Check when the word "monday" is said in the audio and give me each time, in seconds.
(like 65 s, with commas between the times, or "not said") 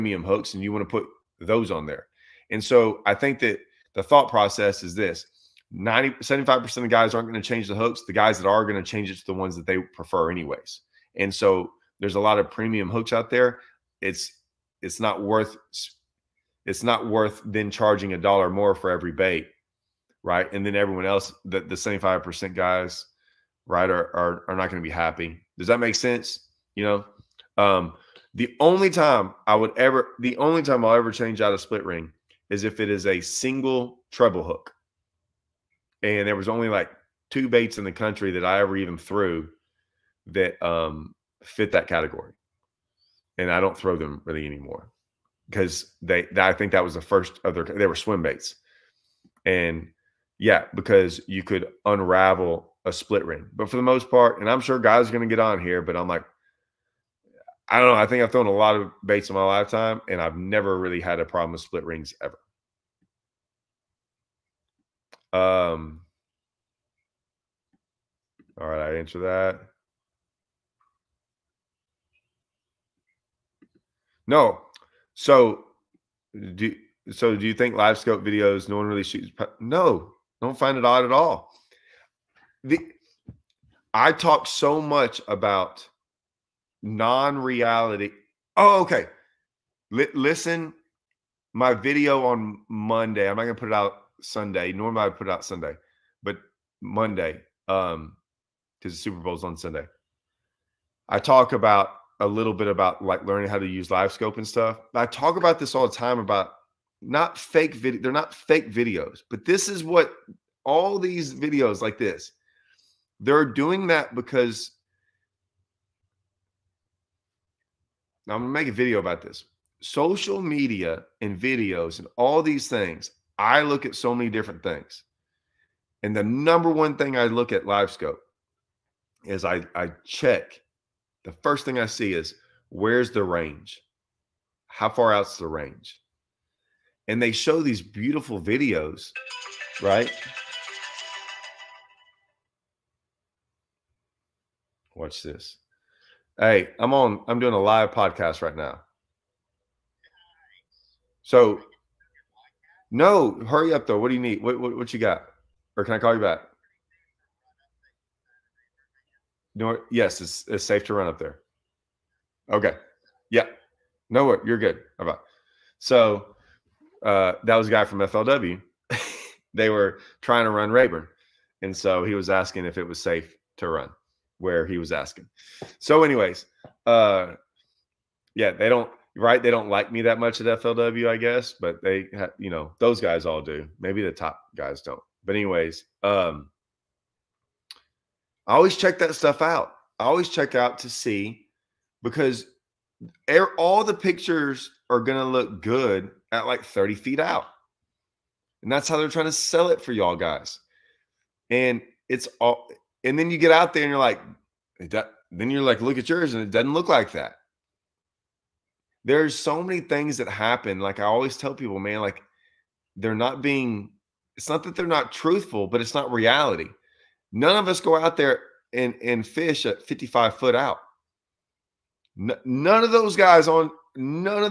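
92 s, 96 s.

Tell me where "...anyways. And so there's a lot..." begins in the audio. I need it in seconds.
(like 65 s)
10 s.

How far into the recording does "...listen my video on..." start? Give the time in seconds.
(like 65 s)
90 s.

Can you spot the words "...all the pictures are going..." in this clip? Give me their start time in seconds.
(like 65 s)
193 s.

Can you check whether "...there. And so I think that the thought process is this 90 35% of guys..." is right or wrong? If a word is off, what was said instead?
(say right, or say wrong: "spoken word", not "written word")
wrong: "75", not "35".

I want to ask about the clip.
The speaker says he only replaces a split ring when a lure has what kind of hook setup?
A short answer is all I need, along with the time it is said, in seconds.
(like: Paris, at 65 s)
single treble hook, at 33 s.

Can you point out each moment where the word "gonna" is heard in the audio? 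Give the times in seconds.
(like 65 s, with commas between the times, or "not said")
93 s, 118 s.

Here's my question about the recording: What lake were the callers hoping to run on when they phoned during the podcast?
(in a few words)
Rayburn.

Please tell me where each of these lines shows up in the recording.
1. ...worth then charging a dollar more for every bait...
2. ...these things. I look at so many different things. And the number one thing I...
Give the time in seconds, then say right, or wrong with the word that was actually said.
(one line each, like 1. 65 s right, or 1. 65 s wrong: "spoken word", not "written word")
1. 17 s right
2. 122 s right.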